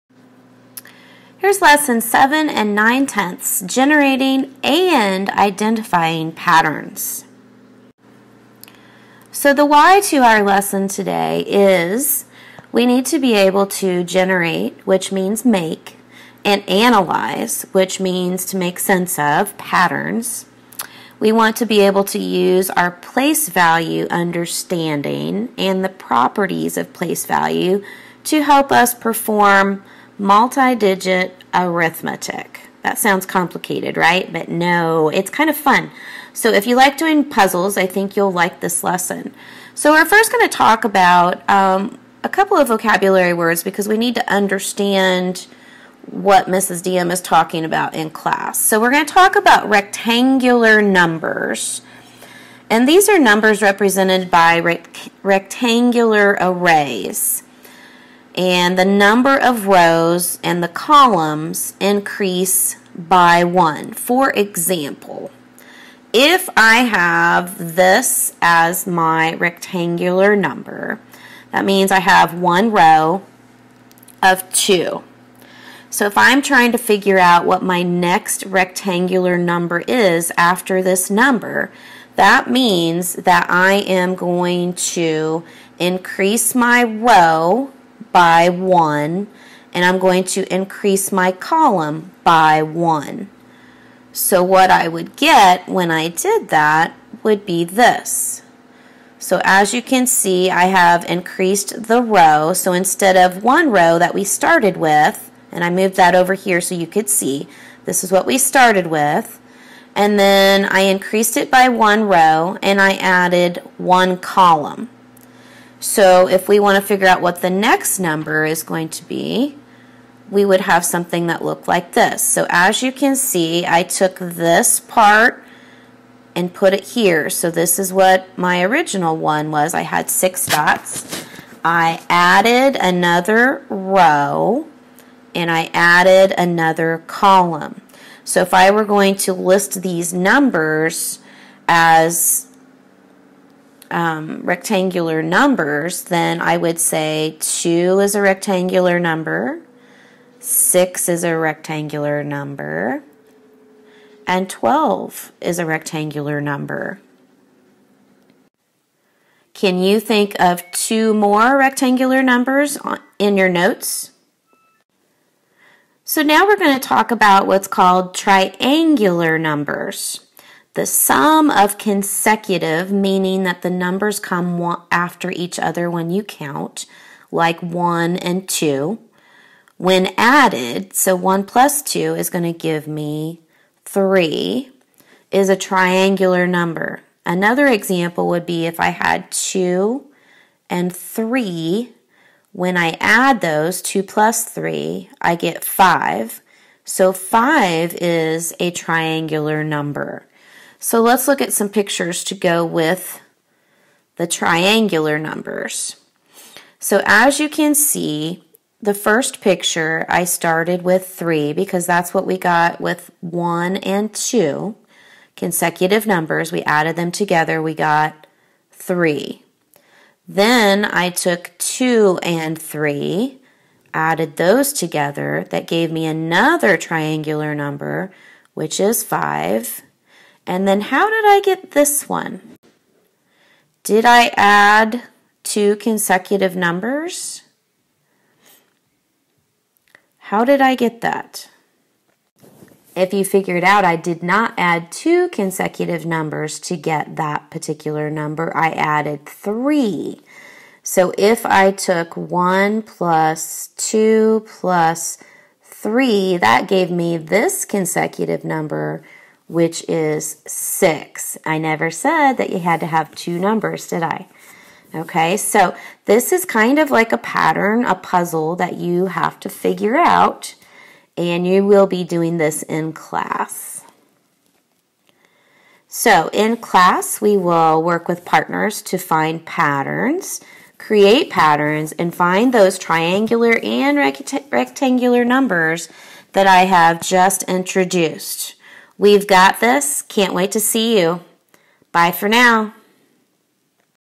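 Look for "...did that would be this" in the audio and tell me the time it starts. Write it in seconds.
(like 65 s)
96 s.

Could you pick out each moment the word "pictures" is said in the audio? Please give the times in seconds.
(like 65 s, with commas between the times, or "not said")
201 s, 209 s.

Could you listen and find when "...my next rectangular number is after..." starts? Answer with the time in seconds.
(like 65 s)
77 s.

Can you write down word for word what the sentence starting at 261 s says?
I never said that you had to have two numbers, did I?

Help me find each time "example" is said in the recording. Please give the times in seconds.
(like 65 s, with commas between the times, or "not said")
64 s, 187 s.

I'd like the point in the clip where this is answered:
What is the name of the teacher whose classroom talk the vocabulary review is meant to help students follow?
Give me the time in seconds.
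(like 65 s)
46 s.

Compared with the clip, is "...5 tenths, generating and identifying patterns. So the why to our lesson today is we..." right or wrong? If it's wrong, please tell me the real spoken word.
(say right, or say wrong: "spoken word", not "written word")
wrong: "9", not "5".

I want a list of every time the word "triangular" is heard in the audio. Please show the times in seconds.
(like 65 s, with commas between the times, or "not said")
168 s, 185 s, 198 s, 204 s, 226 s, 282 s.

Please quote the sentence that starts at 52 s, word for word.
And these are numbers represented by rectangular arrays and the number of rows and the columns increase by one.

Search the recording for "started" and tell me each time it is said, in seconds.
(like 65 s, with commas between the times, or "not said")
104 s, 108 s, 210 s.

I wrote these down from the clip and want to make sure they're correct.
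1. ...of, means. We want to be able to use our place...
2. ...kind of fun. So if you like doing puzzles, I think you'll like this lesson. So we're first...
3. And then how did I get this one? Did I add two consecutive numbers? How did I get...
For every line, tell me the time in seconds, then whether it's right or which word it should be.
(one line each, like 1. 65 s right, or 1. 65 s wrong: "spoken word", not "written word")
1. 19 s wrong: "patterns", not "means"
2. 35 s right
3. 230 s right.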